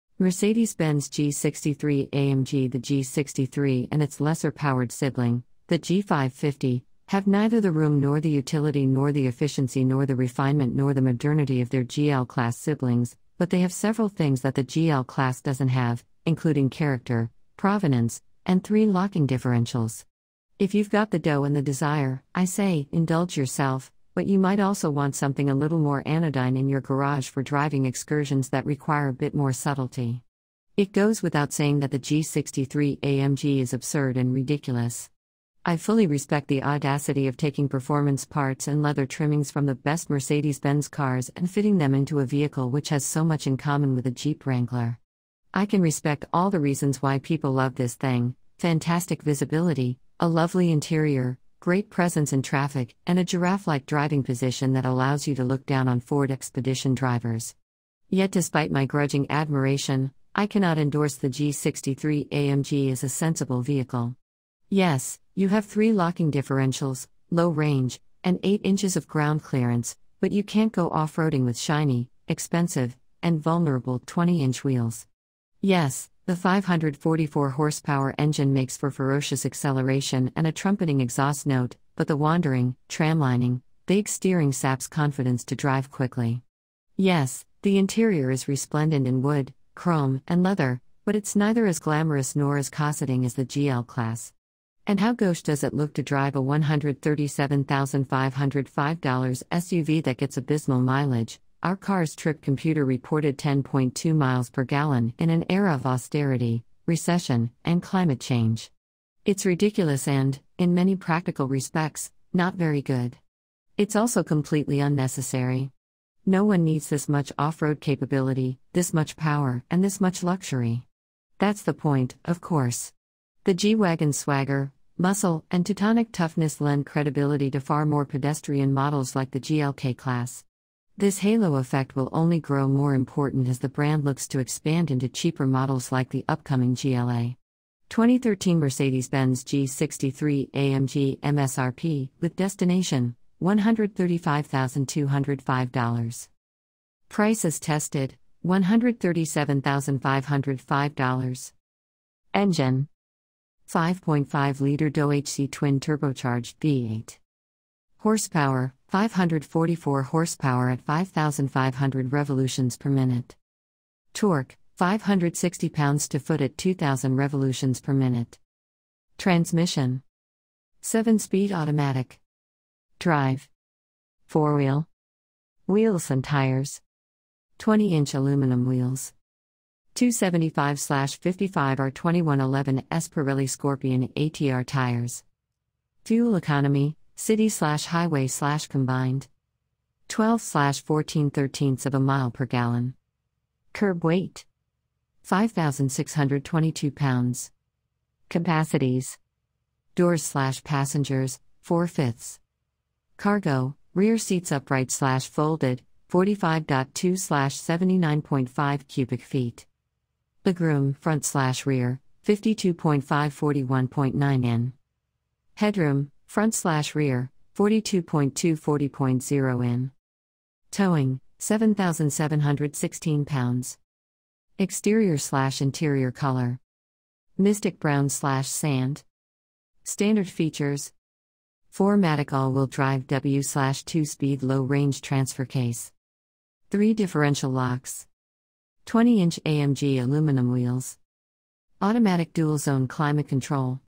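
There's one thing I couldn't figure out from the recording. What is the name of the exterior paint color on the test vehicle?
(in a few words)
Mystic brown.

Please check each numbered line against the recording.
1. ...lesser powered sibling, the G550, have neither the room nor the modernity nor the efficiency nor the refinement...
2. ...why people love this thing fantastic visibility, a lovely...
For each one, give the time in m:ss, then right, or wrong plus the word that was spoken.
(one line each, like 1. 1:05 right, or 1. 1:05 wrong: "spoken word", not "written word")
1. 0:04 wrong: "utility", not "modernity"
2. 0:47 right.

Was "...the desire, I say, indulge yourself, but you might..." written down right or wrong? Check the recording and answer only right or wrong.
right.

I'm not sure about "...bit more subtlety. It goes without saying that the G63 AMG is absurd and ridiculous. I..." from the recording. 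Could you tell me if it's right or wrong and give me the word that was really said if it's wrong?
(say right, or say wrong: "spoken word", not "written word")
right.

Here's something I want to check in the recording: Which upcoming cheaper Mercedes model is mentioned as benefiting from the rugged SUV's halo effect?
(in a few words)
GLA.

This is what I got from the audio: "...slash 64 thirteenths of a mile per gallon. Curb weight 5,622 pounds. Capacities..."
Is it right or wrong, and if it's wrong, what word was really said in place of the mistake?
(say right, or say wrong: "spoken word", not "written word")
wrong: "14", not "64".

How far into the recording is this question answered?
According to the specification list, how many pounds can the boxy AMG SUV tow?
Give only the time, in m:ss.
3:41.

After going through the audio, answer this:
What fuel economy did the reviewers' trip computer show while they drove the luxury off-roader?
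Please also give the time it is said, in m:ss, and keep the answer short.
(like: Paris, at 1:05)
10.2 mpg, at 1:43.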